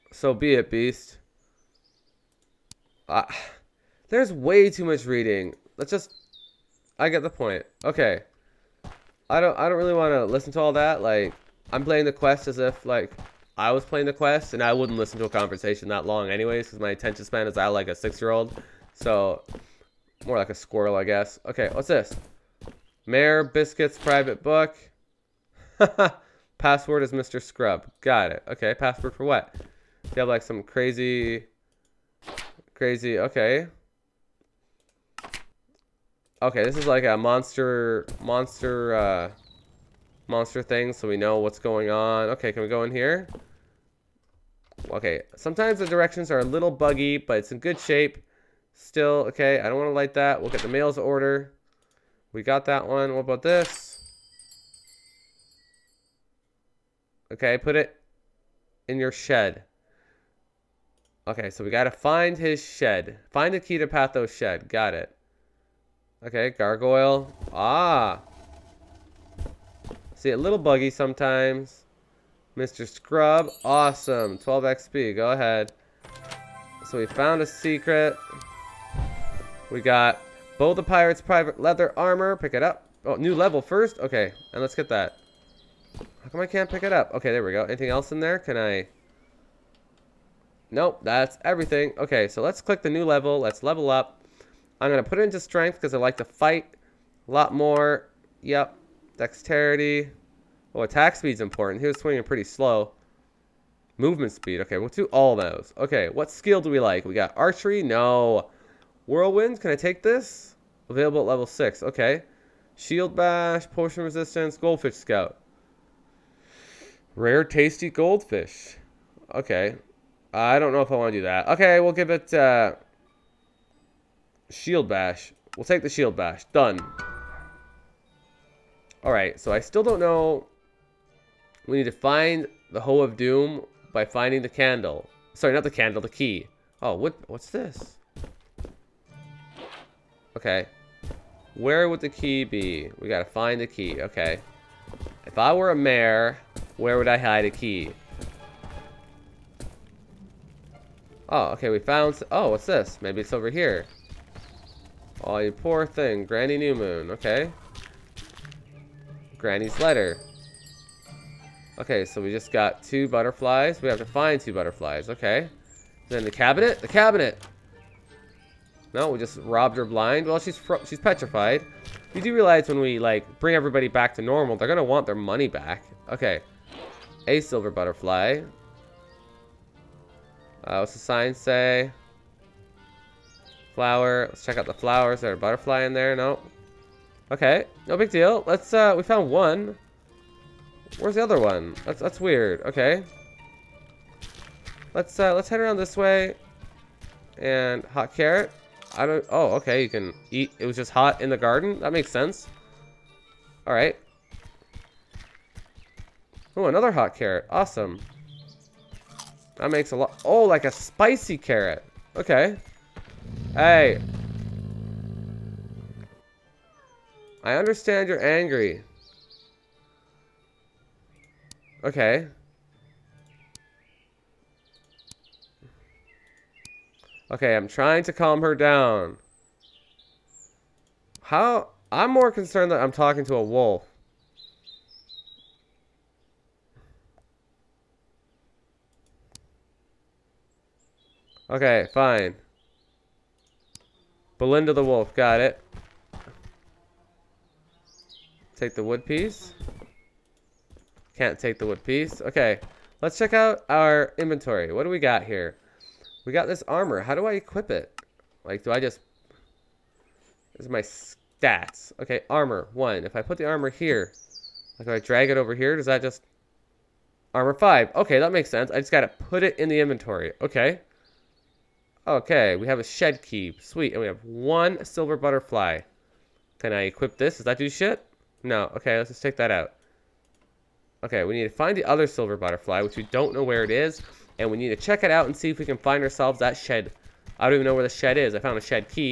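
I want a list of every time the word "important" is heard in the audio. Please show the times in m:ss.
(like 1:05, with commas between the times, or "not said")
1:41.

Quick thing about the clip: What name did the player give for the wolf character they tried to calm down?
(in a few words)
Belinda.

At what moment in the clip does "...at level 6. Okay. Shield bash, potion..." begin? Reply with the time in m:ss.
1:51.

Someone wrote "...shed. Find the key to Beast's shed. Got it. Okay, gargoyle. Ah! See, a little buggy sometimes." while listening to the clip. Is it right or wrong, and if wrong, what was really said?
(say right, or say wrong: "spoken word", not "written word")
wrong: "Patho", not "Beast".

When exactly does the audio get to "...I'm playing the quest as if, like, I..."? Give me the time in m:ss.
0:11.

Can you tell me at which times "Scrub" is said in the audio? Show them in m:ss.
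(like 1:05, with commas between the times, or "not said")
0:27, 1:12.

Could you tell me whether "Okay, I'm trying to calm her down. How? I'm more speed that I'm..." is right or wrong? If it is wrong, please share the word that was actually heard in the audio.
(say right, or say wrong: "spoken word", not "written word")
wrong: "concerned", not "speed".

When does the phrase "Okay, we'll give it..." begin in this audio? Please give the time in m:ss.
2:01.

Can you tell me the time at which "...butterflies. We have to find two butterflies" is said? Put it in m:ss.
2:43.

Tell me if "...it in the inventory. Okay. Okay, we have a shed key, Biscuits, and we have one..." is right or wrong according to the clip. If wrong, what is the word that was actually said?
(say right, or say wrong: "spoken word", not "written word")
wrong: "Sweet", not "Biscuits".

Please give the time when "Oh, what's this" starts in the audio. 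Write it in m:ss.
2:32.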